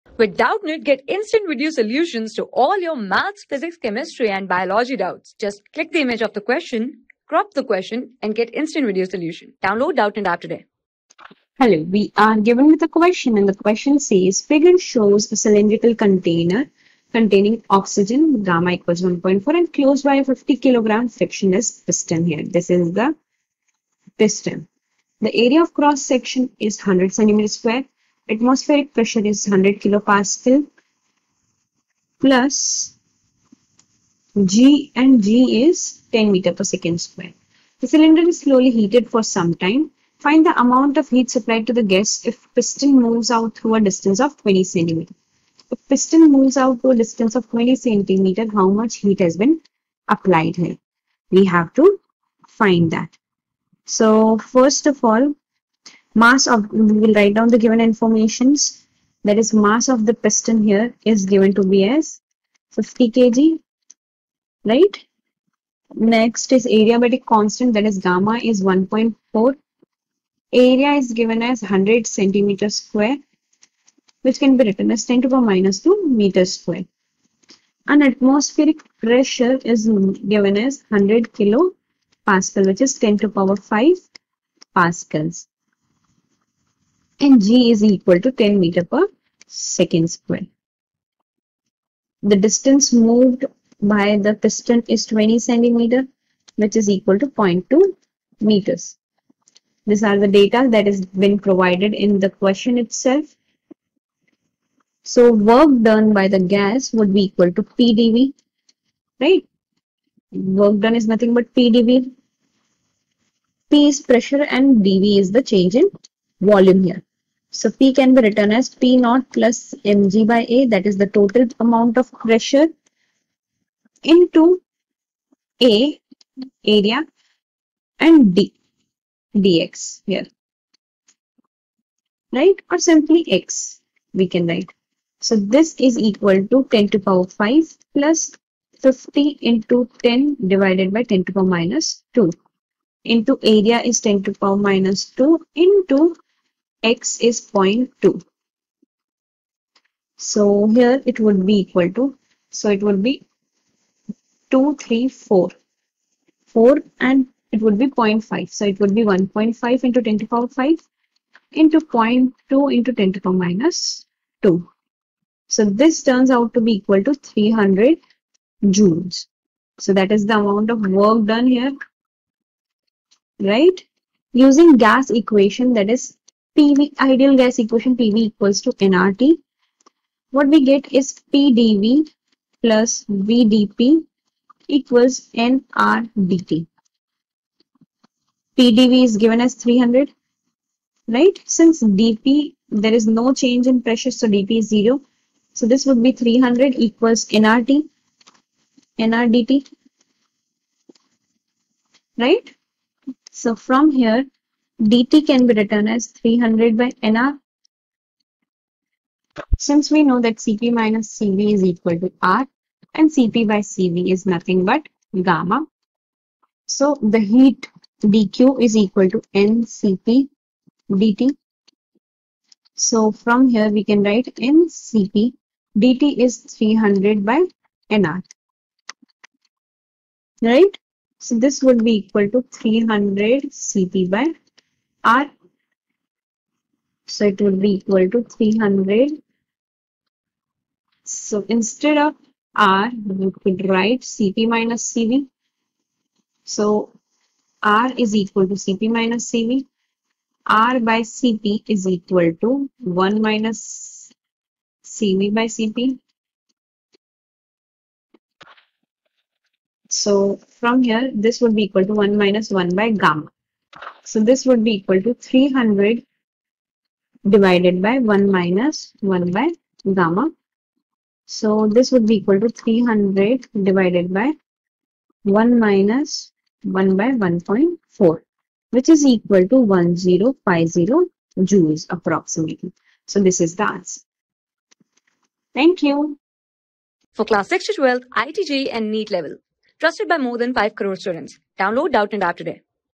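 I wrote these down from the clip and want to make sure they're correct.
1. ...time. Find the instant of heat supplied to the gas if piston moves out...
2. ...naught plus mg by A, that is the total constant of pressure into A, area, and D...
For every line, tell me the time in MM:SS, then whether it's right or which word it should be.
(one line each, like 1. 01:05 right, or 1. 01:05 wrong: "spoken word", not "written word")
1. 00:39 wrong: "amount", not "instant"
2. 01:58 wrong: "amount", not "constant".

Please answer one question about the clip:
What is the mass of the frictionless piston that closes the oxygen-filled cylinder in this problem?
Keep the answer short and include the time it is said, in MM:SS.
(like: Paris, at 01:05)
50 kg, at 00:20.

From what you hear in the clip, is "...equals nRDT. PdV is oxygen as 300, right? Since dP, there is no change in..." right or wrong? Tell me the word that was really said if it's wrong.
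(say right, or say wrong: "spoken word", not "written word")
wrong: "given", not "oxygen".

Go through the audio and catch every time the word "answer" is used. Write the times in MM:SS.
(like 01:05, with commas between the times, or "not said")
04:43.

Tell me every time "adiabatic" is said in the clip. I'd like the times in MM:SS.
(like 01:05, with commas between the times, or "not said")
01:06.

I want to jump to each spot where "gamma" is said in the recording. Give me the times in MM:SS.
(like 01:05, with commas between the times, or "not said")
00:18, 01:07, 03:35, 04:22, 04:29.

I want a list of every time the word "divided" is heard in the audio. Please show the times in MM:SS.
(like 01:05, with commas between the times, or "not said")
02:20, 04:27, 04:33.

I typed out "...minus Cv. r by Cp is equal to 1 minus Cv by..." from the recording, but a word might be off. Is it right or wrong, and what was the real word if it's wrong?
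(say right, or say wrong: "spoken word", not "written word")
right.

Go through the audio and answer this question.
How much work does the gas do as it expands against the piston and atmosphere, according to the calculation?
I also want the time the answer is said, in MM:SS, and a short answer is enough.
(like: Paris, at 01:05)
300 joules, at 02:47.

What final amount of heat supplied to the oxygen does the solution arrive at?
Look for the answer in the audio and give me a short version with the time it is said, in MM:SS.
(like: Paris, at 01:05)
1050 joules, at 04:39.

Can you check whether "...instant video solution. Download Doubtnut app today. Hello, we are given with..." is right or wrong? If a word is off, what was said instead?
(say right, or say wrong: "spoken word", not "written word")
right.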